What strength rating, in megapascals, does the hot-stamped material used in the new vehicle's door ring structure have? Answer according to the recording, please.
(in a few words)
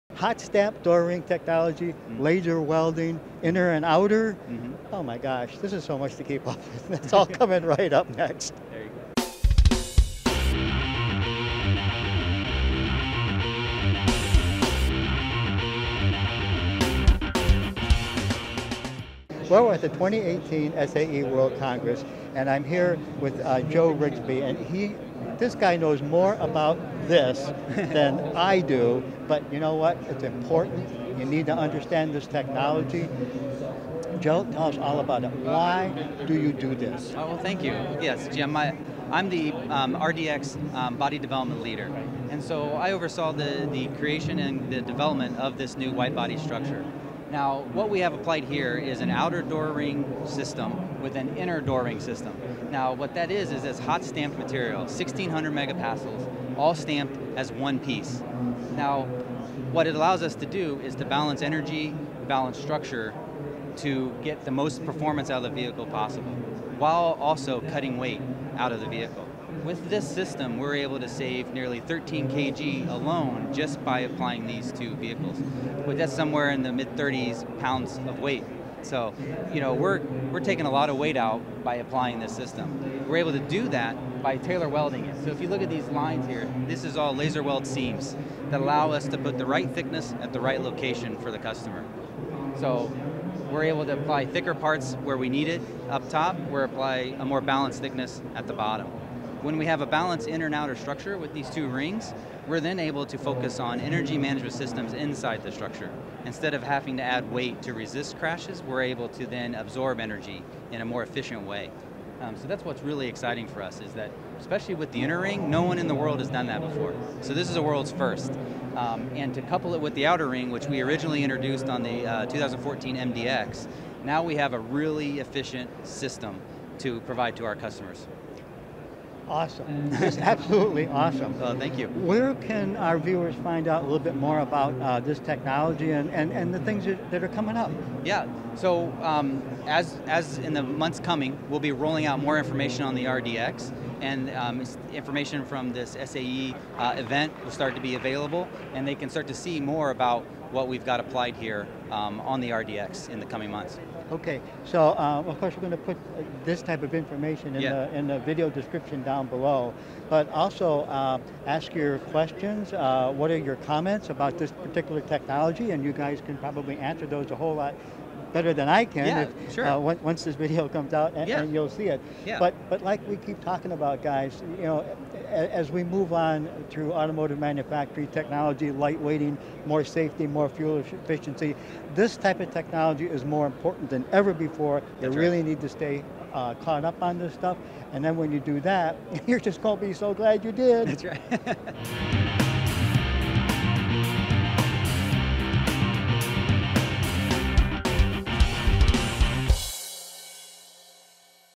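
1600 megapascals.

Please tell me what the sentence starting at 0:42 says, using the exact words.
And so I oversaw the, the creation and the development of this new white body structure.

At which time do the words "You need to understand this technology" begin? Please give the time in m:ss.
0:31.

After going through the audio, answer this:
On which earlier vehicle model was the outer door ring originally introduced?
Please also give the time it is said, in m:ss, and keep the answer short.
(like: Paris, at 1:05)
2014 MDX, at 2:02.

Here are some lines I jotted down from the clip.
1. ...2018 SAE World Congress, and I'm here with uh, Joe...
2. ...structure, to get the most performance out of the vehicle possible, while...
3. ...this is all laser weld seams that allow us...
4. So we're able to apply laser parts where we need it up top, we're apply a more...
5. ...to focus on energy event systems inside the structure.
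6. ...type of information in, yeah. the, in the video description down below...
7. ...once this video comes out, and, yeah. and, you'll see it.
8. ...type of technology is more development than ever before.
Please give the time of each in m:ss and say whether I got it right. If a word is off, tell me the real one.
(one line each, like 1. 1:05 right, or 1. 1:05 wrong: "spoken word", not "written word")
1. 0:19 right
2. 1:02 right
3. 1:26 right
4. 1:32 wrong: "thicker", not "laser"
5. 1:43 wrong: "management", not "event"
6. 2:36 right
7. 2:49 right
8. 3:02 wrong: "important", not "development".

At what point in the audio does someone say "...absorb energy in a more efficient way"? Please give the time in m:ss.
1:49.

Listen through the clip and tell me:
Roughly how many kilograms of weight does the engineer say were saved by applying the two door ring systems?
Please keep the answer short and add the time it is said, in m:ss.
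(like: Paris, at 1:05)
13 kg, at 1:11.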